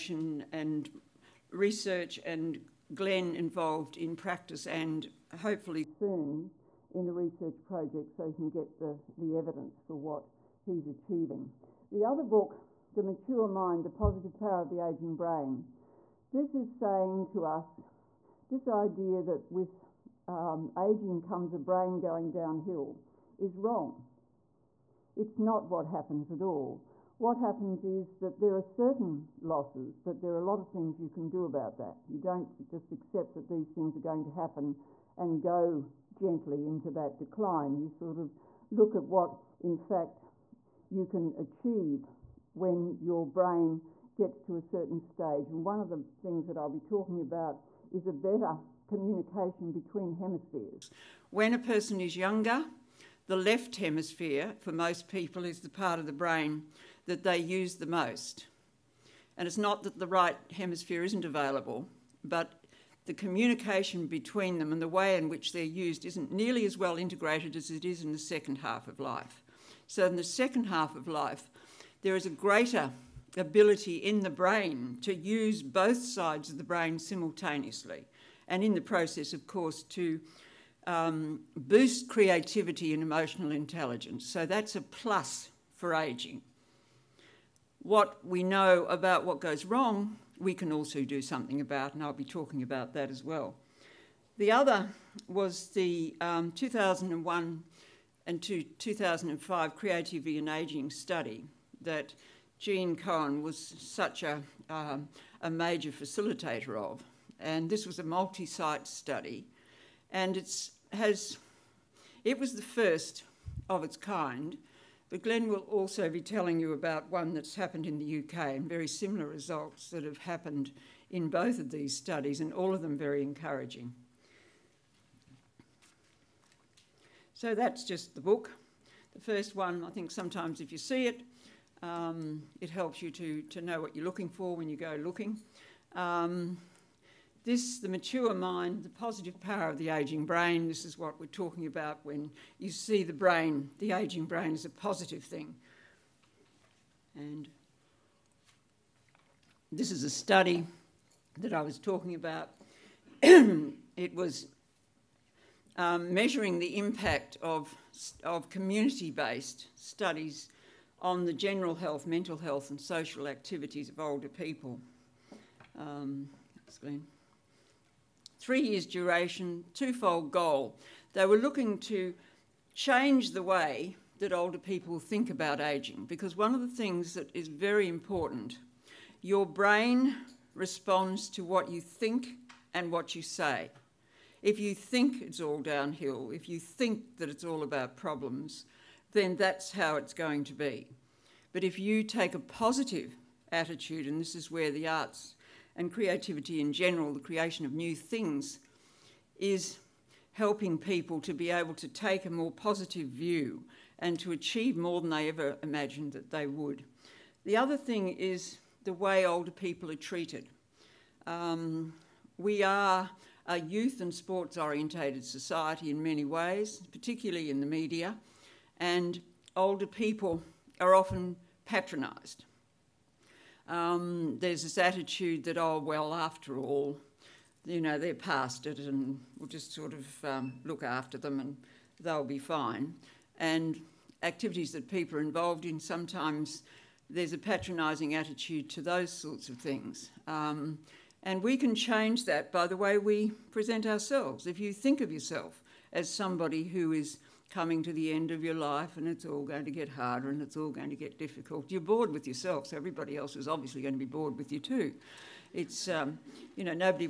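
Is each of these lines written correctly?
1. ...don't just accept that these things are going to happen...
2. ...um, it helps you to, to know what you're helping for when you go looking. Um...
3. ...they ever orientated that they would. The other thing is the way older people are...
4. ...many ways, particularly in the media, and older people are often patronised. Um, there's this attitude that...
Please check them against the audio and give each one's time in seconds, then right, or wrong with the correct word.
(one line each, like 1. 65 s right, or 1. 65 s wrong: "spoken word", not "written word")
1. 32 s right
2. 131 s wrong: "looking", not "helping"
3. 205 s wrong: "imagined", not "orientated"
4. 216 s right.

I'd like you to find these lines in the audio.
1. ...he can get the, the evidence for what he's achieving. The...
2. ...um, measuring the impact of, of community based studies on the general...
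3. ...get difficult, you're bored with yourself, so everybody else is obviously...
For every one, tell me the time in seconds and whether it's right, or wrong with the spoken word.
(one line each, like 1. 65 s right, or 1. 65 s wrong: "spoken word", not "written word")
1. 8 s right
2. 155 s right
3. 250 s right.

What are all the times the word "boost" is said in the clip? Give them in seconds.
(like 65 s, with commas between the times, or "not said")
81 s.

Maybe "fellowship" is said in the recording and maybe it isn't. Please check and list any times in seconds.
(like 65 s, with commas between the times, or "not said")
not said.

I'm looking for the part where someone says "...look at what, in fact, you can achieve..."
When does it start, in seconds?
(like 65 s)
38 s.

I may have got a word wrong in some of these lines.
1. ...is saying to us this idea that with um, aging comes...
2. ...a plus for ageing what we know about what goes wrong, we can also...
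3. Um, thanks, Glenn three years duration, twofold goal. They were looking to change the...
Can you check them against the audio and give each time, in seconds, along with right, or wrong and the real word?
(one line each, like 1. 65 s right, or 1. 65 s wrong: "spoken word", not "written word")
1. 16 s right
2. 84 s right
3. 165 s right.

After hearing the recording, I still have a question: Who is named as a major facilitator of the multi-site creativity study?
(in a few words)
Gene Cohen.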